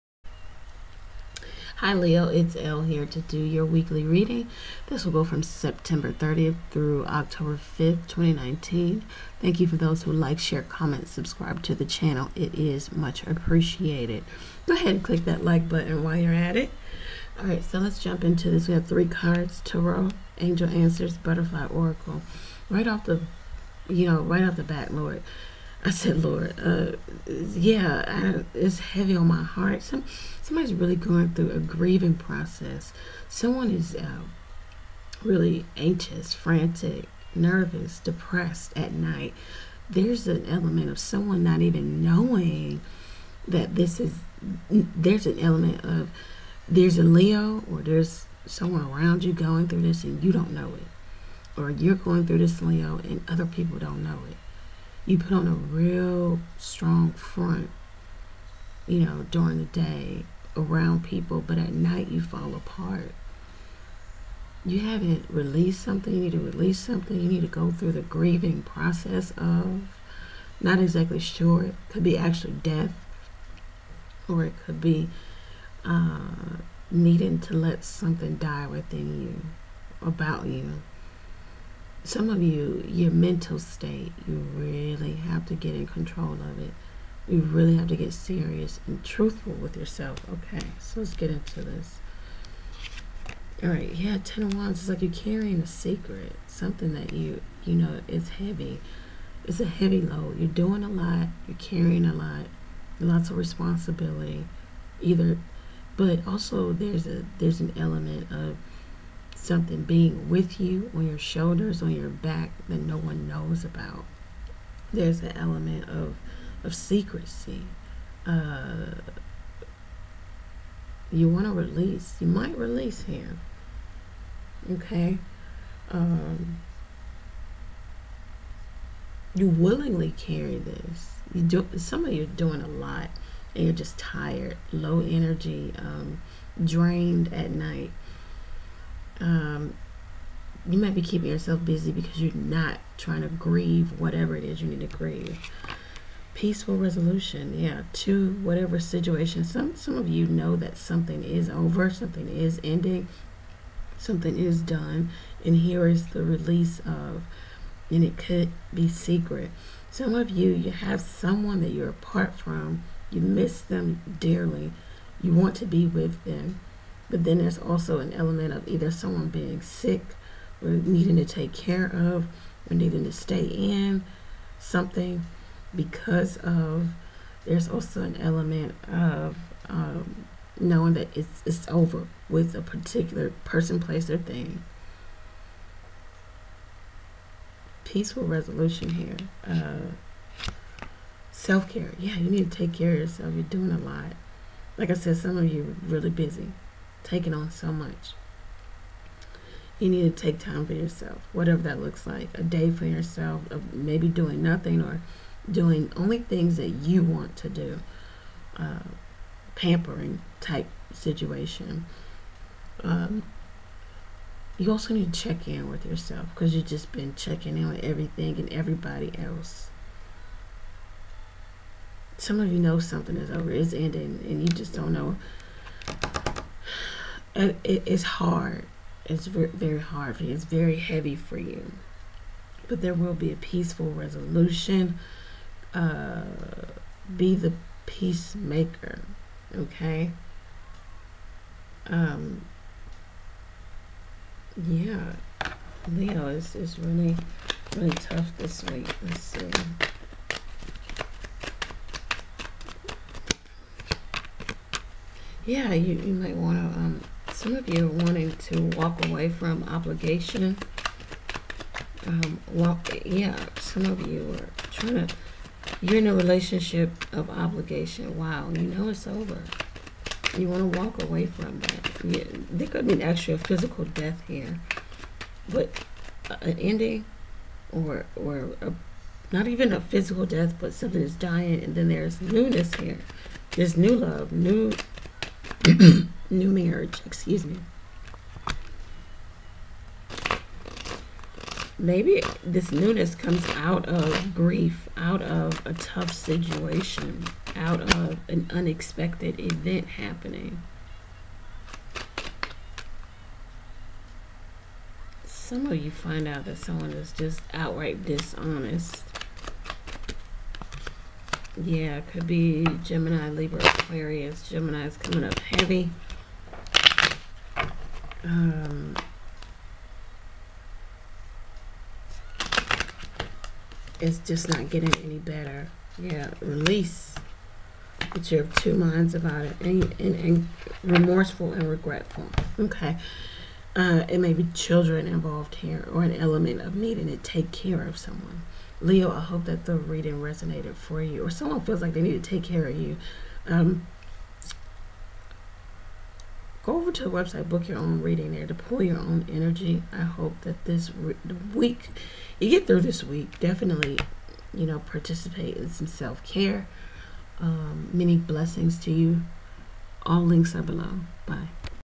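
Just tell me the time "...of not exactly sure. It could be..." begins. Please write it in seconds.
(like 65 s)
69 s.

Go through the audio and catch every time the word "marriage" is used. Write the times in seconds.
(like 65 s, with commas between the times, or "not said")
286 s.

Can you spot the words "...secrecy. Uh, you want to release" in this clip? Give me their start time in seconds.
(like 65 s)
116 s.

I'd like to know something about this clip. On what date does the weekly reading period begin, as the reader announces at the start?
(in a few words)
September 30th.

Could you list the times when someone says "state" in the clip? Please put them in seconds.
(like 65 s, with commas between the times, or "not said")
83 s.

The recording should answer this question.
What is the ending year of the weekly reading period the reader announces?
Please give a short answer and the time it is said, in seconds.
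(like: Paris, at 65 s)
2019, at 8 s.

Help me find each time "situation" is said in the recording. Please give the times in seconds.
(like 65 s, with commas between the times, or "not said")
148 s, 210 s, 296 s.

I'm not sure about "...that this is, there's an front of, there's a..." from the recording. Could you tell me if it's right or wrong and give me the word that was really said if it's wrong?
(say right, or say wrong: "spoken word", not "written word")
wrong: "element", not "front".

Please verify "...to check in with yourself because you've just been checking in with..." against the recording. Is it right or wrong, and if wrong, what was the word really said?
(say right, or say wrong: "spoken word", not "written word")
right.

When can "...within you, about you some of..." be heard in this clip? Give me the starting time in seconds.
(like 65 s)
78 s.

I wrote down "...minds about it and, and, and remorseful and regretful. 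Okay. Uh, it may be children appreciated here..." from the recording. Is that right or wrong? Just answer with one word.
wrong.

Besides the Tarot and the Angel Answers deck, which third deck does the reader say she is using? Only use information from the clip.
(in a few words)
Butterfly Oracle.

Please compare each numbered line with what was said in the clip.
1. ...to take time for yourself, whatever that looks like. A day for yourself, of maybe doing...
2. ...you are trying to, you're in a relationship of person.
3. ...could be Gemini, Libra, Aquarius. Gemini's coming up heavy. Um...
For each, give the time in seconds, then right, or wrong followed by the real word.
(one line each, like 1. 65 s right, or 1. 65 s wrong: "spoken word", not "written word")
1. 200 s right
2. 264 s wrong: "obligation", not "person"
3. 312 s right.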